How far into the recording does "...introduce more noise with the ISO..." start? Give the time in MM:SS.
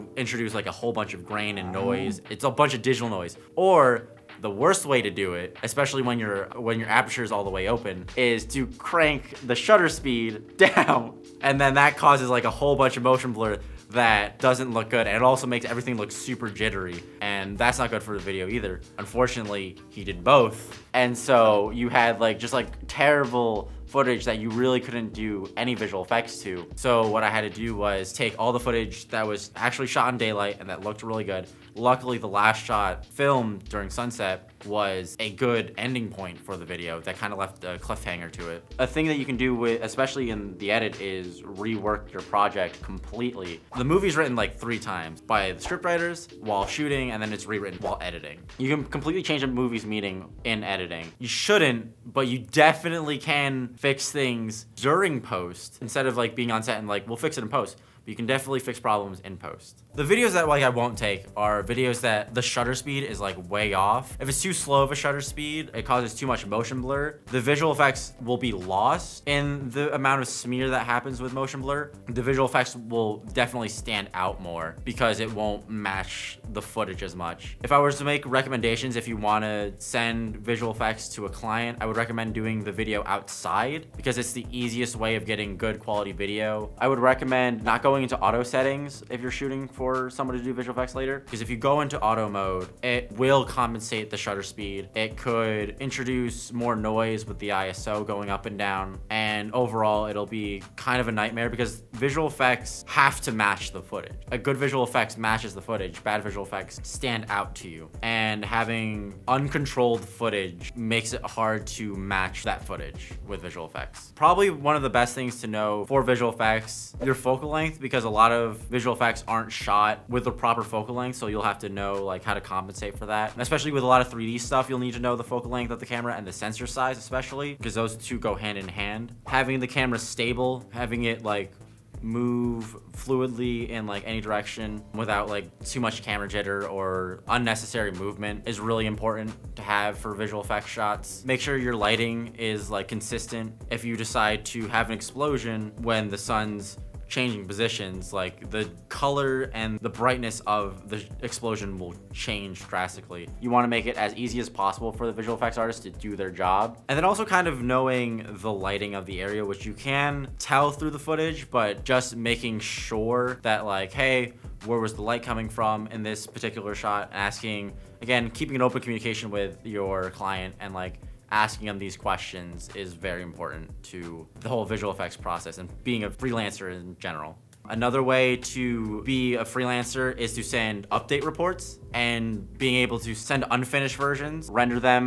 01:35.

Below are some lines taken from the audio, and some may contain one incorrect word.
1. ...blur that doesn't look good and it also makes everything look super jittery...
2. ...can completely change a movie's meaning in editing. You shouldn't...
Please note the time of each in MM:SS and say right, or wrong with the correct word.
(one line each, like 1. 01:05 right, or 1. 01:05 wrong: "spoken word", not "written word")
1. 00:13 right
2. 00:48 right.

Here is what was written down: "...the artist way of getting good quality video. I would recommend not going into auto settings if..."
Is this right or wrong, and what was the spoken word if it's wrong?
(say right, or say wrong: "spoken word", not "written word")
wrong: "easiest", not "artist".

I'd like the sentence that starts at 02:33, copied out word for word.
You wanna make it as easy as possible for the visual effects artist to do their job.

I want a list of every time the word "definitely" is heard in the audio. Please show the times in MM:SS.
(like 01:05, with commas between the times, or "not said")
00:52, 00:58, 01:13.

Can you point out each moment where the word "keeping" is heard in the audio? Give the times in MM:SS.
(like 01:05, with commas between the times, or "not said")
02:48.